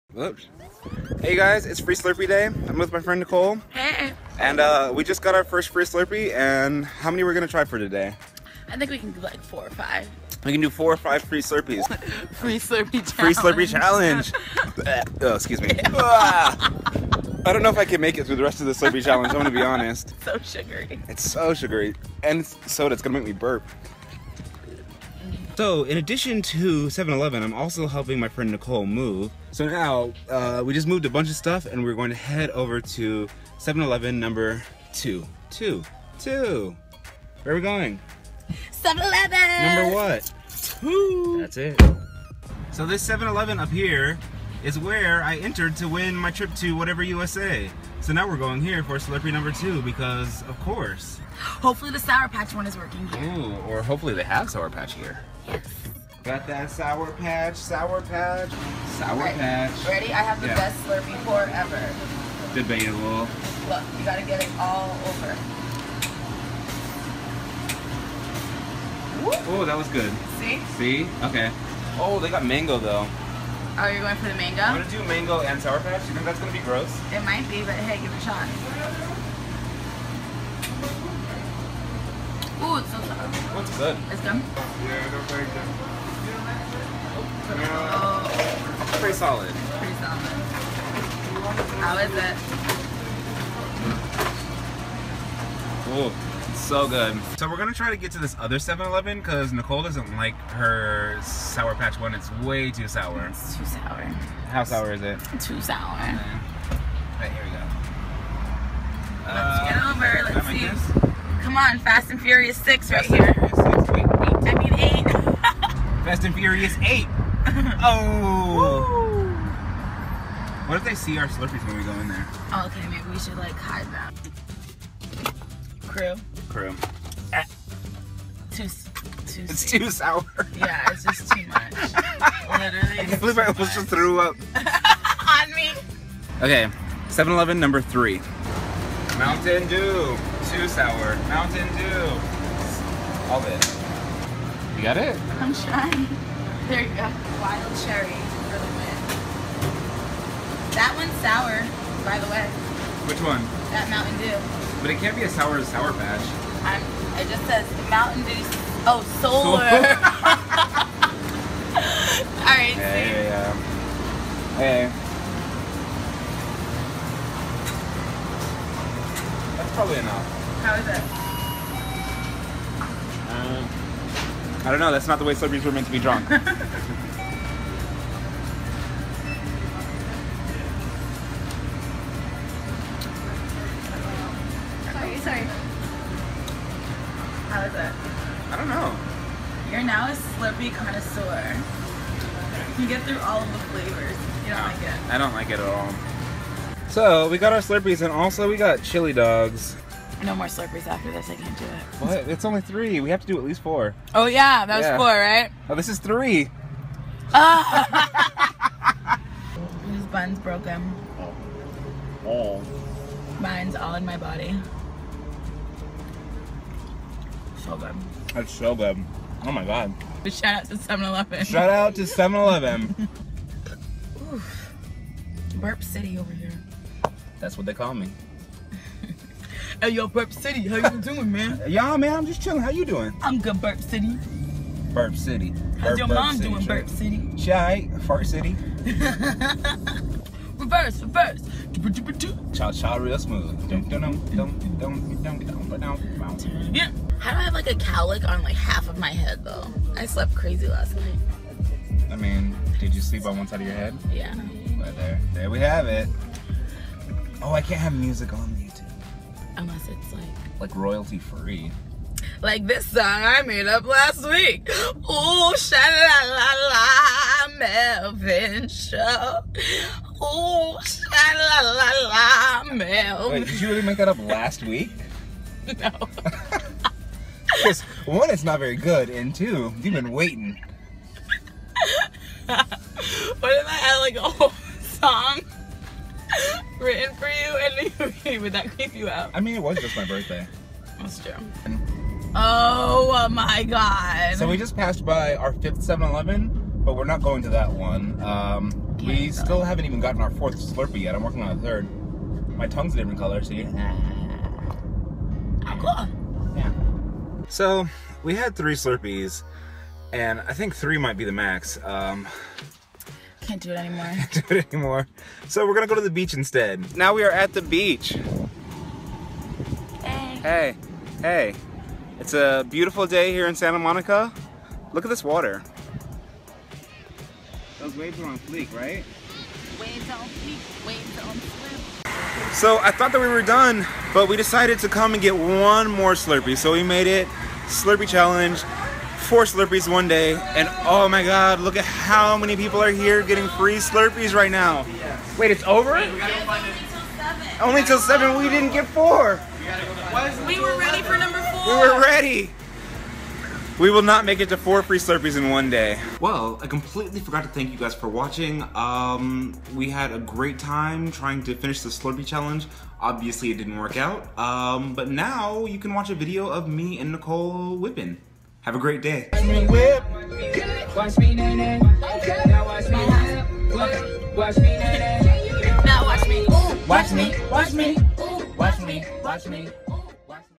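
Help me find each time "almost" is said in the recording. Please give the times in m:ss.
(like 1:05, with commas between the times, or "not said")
2:13.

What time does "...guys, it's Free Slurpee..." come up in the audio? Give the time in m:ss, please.
0:01.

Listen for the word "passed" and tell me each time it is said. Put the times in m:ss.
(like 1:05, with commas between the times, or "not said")
4:54.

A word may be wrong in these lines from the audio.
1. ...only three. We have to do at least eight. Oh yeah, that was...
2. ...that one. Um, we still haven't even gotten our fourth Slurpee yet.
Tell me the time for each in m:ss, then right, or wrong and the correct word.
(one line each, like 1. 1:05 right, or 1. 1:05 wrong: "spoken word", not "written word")
1. 3:22 wrong: "four", not "eight"
2. 4:57 right.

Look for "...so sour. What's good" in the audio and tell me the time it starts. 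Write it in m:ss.
1:22.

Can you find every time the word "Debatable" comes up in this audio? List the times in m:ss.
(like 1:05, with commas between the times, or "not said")
1:02.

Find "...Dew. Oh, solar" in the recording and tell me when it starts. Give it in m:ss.
2:38.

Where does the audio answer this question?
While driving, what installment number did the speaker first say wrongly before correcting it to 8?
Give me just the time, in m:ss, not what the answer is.
1:51.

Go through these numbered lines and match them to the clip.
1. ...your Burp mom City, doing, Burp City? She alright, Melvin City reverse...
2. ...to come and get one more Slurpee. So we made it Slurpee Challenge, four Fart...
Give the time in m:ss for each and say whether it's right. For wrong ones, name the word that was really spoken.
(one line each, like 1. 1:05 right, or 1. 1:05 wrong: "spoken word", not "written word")
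1. 3:55 wrong: "Fart", not "Melvin"
2. 5:34 wrong: "Slurpees", not "Fart".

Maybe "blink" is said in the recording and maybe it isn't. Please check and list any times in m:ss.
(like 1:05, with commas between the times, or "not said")
not said.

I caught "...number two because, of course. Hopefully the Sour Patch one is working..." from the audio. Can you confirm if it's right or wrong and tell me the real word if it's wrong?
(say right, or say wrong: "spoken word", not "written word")
right.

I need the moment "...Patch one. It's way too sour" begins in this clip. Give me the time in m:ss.
1:41.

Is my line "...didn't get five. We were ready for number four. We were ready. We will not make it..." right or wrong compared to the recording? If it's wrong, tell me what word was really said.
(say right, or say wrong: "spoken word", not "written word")
wrong: "four", not "five".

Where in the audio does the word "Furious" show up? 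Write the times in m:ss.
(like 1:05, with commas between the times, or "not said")
1:52, 1:56.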